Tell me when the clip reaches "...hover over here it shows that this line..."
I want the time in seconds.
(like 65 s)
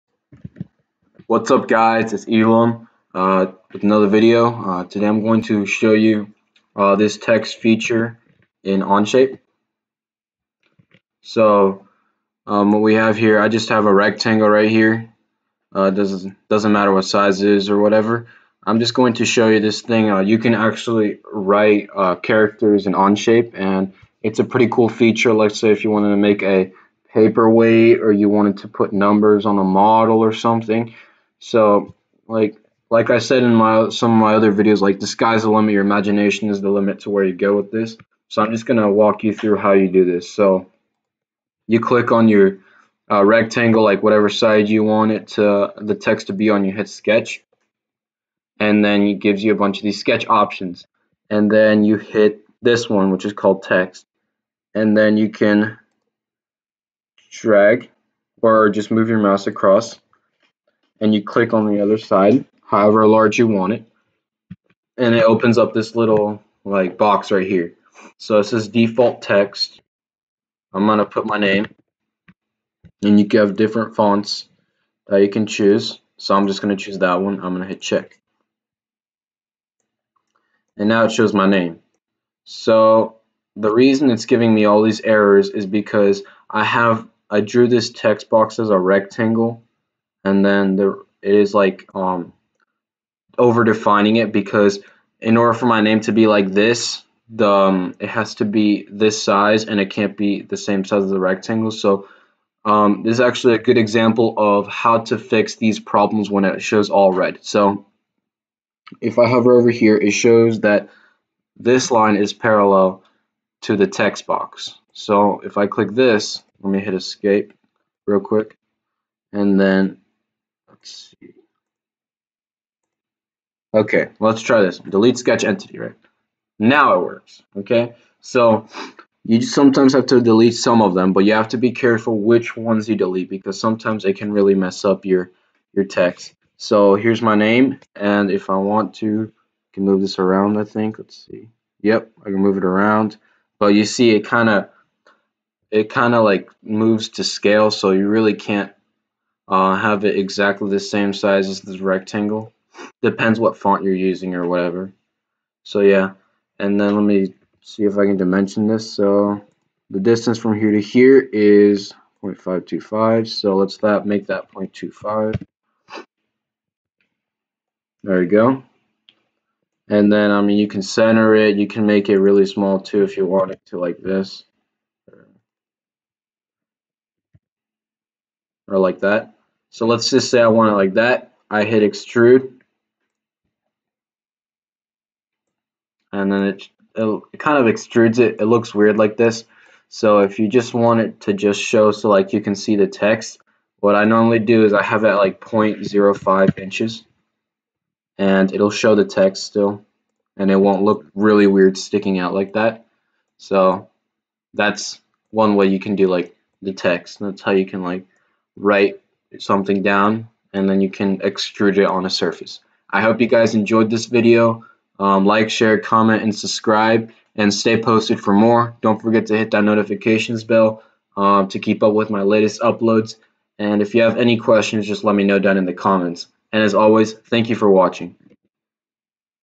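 109 s.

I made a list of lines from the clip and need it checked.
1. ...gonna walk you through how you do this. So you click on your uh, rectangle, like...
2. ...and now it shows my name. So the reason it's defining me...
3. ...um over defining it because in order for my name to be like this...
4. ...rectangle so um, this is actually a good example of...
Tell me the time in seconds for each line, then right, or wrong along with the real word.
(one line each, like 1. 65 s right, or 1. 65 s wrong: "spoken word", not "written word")
1. 38 s right
2. 80 s wrong: "giving", not "defining"
3. 91 s right
4. 101 s right.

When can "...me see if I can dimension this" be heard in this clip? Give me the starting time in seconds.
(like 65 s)
157 s.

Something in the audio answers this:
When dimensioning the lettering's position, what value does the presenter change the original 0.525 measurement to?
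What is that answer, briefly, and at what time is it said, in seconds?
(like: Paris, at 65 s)
0.25, at 164 s.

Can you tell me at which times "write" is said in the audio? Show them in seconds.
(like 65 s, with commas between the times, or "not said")
21 s, 208 s.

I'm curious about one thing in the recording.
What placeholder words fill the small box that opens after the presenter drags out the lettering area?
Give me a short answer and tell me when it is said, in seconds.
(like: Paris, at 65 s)
default text, at 68 s.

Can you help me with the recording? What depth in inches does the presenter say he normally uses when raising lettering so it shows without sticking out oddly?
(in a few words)
0.05 inches.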